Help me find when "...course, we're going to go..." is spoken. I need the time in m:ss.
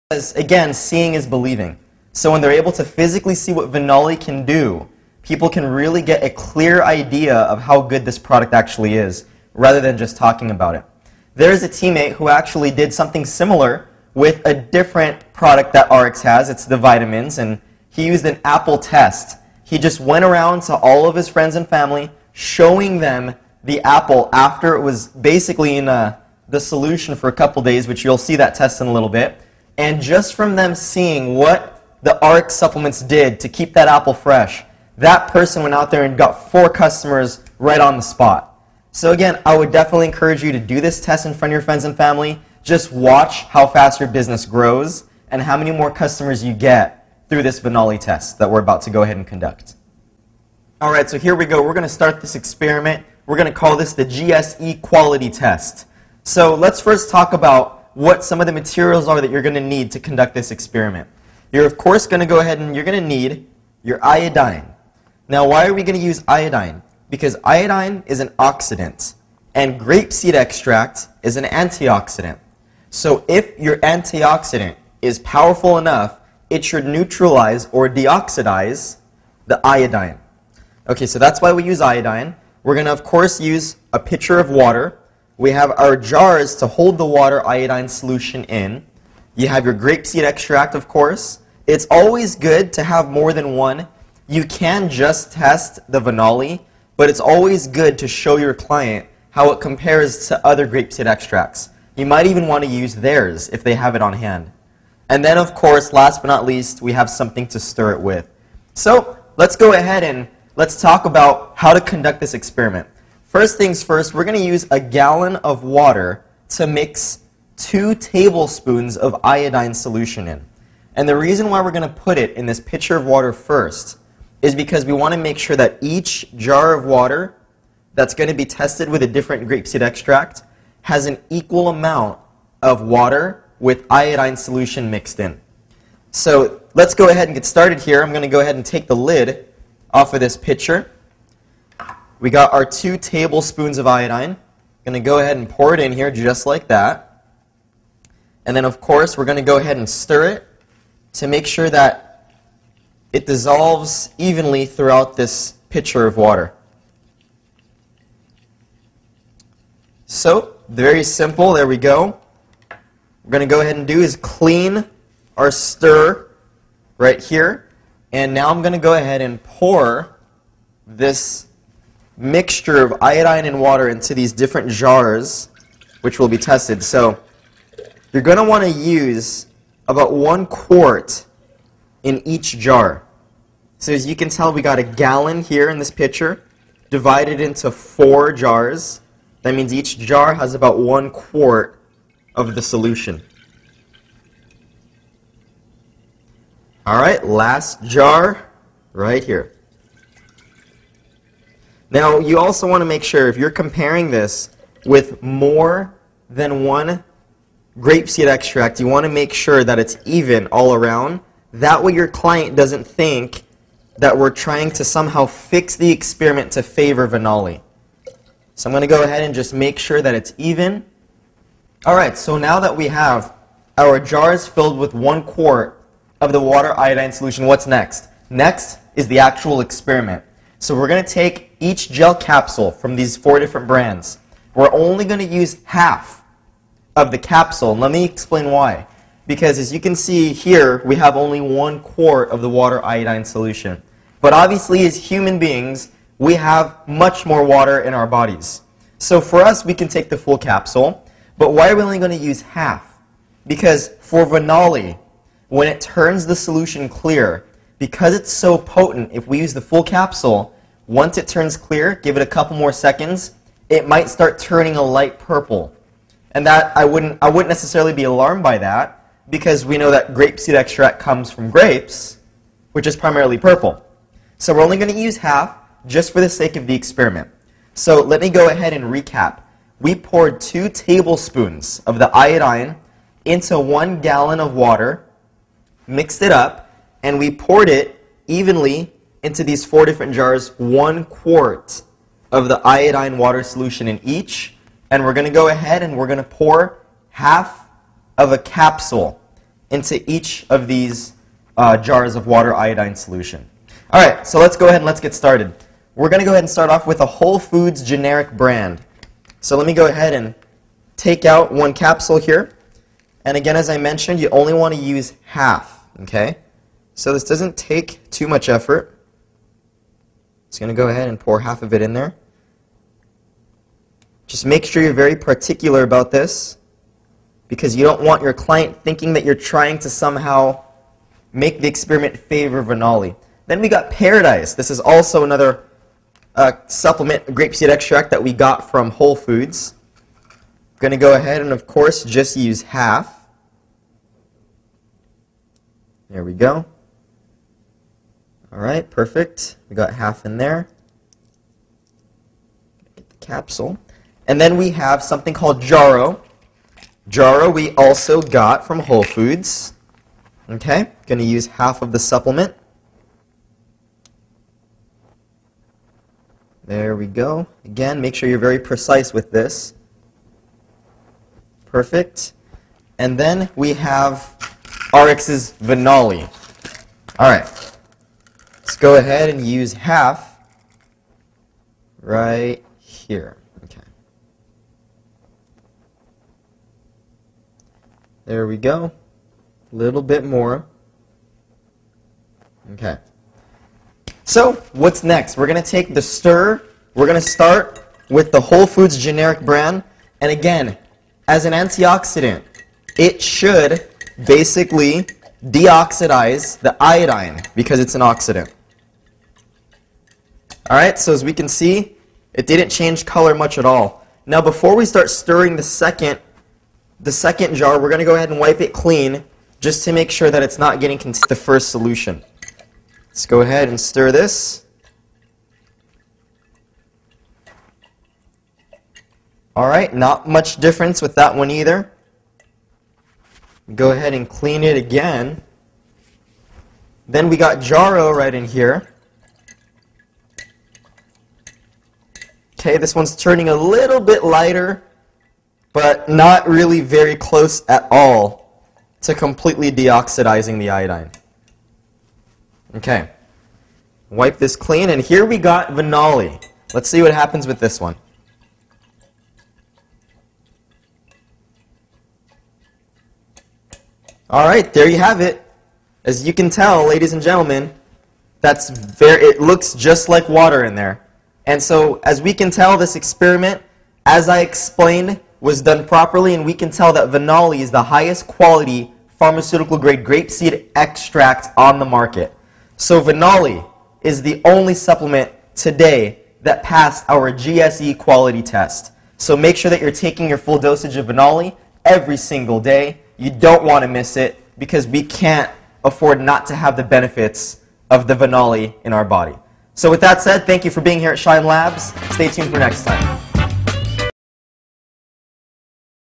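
2:28.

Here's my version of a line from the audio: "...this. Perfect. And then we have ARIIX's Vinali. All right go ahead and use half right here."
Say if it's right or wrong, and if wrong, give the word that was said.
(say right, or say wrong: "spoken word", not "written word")
right.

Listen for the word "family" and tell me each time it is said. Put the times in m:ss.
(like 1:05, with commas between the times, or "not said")
0:21, 0:41.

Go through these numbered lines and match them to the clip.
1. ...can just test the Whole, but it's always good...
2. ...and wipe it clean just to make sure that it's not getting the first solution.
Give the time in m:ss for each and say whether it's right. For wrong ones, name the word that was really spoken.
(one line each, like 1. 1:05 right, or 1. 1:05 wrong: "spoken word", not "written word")
1. 1:34 wrong: "Vinali", not "Whole"
2. 6:58 right.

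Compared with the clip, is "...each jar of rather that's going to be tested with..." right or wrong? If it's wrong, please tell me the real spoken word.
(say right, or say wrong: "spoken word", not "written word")
wrong: "water", not "rather".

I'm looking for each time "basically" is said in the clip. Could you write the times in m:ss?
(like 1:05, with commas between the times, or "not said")
0:25, 6:44.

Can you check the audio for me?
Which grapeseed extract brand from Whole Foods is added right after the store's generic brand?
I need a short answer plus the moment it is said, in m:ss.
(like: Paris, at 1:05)
Paradise, at 5:33.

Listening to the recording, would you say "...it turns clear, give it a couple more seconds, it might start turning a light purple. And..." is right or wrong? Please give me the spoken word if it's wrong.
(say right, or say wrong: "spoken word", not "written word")
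right.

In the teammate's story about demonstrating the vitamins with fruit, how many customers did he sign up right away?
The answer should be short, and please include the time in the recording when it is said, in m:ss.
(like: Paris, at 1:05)
4, at 0:36.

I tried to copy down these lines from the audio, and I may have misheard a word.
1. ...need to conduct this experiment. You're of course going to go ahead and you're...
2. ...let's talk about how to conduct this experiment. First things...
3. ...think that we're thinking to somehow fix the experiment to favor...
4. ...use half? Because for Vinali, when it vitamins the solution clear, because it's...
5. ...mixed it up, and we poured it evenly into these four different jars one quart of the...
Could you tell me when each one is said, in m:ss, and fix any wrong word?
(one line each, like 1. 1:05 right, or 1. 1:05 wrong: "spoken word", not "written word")
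1. 0:59 right
2. 1:50 right
3. 3:32 wrong: "trying", not "thinking"
4. 4:12 wrong: "turns", not "vitamins"
5. 4:45 right.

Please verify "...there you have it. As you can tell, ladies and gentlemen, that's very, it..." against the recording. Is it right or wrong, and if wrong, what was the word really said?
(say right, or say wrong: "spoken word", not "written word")
right.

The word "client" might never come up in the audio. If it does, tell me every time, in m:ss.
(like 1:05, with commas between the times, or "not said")
1:38, 3:32, 5:28.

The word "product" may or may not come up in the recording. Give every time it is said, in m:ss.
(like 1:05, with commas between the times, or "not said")
0:08, 0:15.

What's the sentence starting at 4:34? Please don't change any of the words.
So we're only going to use half just for the sake of the experiment.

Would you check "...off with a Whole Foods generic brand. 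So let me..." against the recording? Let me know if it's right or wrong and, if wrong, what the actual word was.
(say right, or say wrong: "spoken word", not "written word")
right.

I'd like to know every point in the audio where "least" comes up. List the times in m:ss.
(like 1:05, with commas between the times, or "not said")
1:46.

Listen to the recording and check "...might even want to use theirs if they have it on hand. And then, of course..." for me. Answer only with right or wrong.
right.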